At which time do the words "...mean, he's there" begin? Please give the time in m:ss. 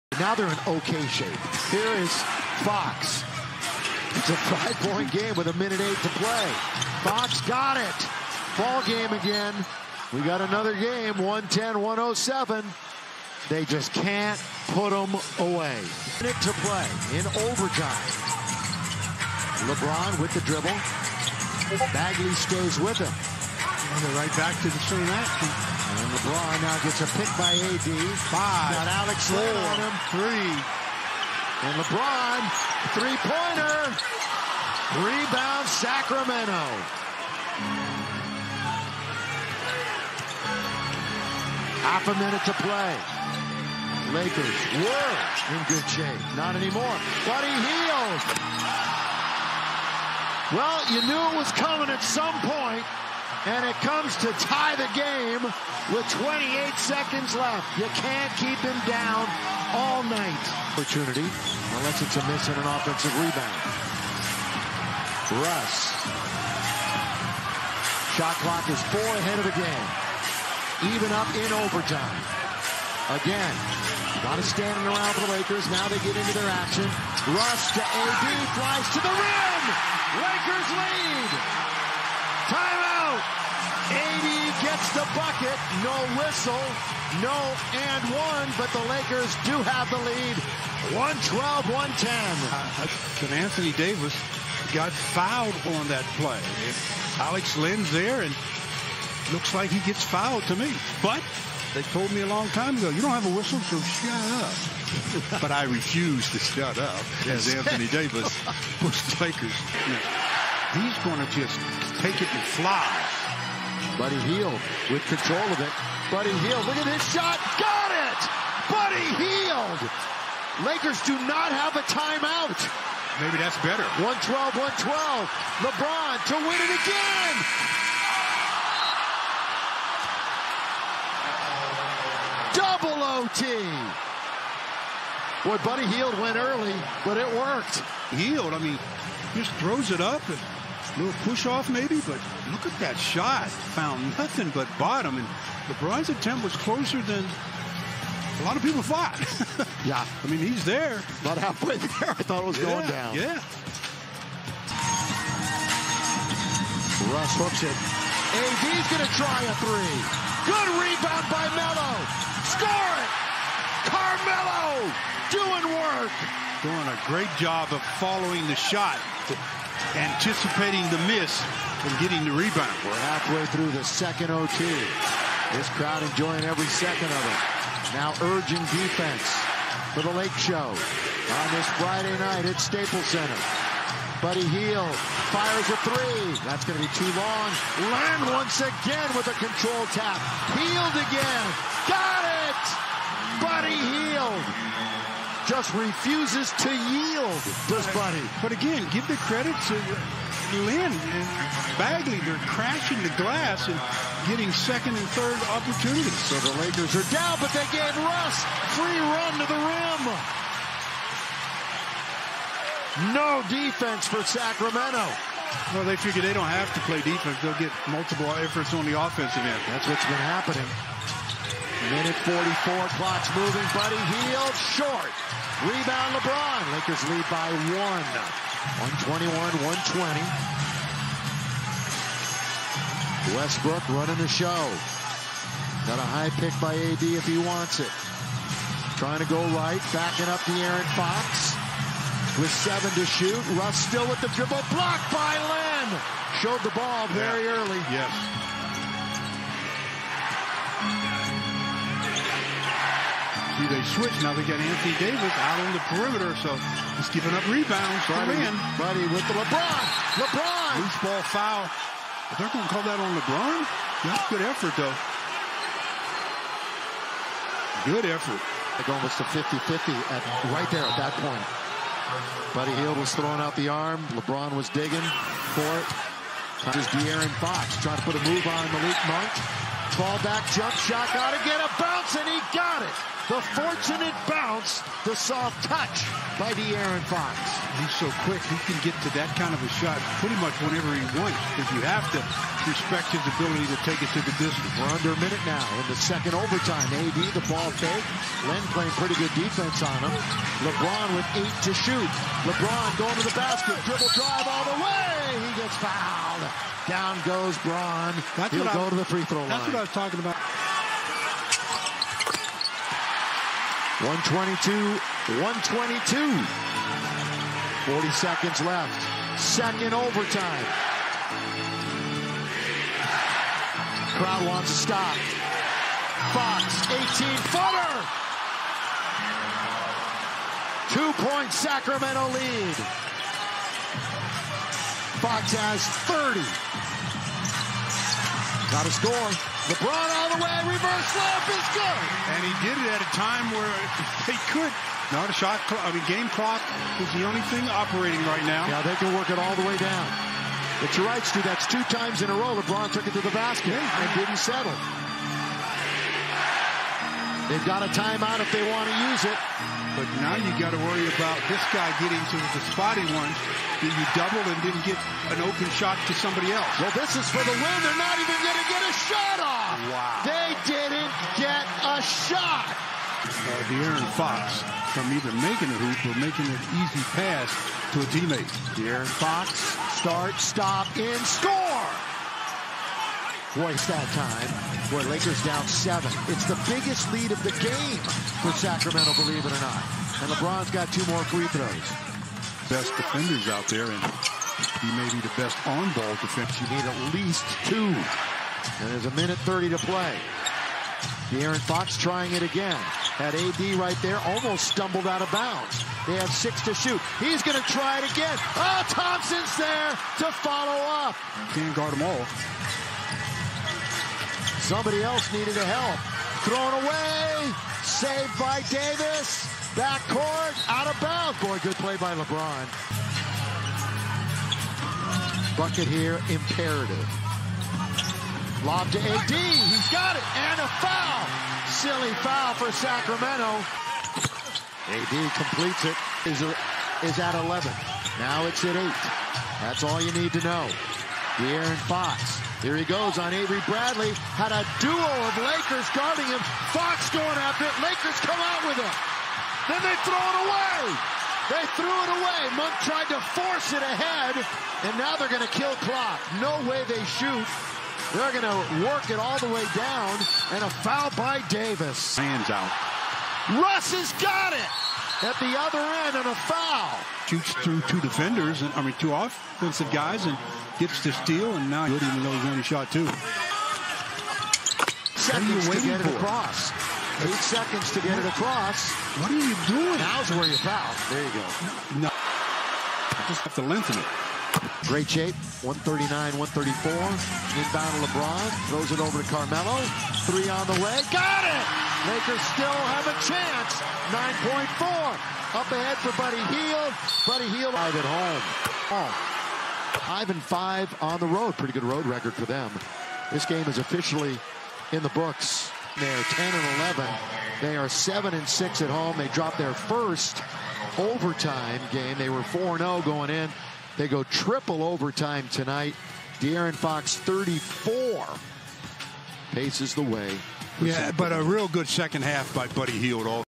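2:30.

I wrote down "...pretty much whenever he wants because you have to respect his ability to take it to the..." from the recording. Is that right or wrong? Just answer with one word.
right.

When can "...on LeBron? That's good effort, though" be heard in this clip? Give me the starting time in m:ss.
4:22.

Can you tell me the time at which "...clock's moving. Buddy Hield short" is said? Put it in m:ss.
3:43.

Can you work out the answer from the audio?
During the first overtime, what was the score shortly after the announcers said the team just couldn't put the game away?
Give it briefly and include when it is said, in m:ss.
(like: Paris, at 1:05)
110-107, at 0:11.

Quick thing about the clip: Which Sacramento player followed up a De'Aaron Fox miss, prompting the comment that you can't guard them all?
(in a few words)
Thompson.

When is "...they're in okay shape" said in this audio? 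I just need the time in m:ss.
0:00.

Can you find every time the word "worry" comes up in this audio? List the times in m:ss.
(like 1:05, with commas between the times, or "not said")
6:00.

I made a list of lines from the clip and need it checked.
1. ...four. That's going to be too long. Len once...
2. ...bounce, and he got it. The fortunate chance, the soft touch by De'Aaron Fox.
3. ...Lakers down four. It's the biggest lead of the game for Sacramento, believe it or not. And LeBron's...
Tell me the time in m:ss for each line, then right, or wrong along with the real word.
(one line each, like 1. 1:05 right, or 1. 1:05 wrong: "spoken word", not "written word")
1. 3:05 wrong: "three", not "four"
2. 4:41 wrong: "bounce", not "chance"
3. 6:25 wrong: "seven", not "four".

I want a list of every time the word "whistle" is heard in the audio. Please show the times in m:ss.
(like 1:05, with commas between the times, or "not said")
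1:26, 1:43.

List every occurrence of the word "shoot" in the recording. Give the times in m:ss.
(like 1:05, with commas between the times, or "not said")
4:03, 5:01, 6:46, 7:37, 7:47.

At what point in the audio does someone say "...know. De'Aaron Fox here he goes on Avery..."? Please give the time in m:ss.
7:20.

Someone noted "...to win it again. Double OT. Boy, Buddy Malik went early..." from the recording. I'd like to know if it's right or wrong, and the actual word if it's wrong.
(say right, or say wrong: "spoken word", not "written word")
wrong: "Hield", not "Malik".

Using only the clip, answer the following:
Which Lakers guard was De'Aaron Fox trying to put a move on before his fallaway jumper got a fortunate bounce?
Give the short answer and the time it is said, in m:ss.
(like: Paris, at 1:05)
Malik Monk, at 4:38.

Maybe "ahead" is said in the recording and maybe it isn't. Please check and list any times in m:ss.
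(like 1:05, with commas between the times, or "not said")
1:09, 7:33, 8:15.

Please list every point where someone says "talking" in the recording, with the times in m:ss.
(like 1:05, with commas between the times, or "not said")
5:09.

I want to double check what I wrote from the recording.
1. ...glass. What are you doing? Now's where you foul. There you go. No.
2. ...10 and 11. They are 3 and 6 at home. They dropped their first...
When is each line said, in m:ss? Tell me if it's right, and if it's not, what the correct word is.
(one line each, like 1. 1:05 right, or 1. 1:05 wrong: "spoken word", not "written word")
1. 7:58 wrong: "across", not "glass"
2. 8:26 wrong: "7", not "3".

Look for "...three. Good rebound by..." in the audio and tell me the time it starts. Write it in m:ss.
2:39.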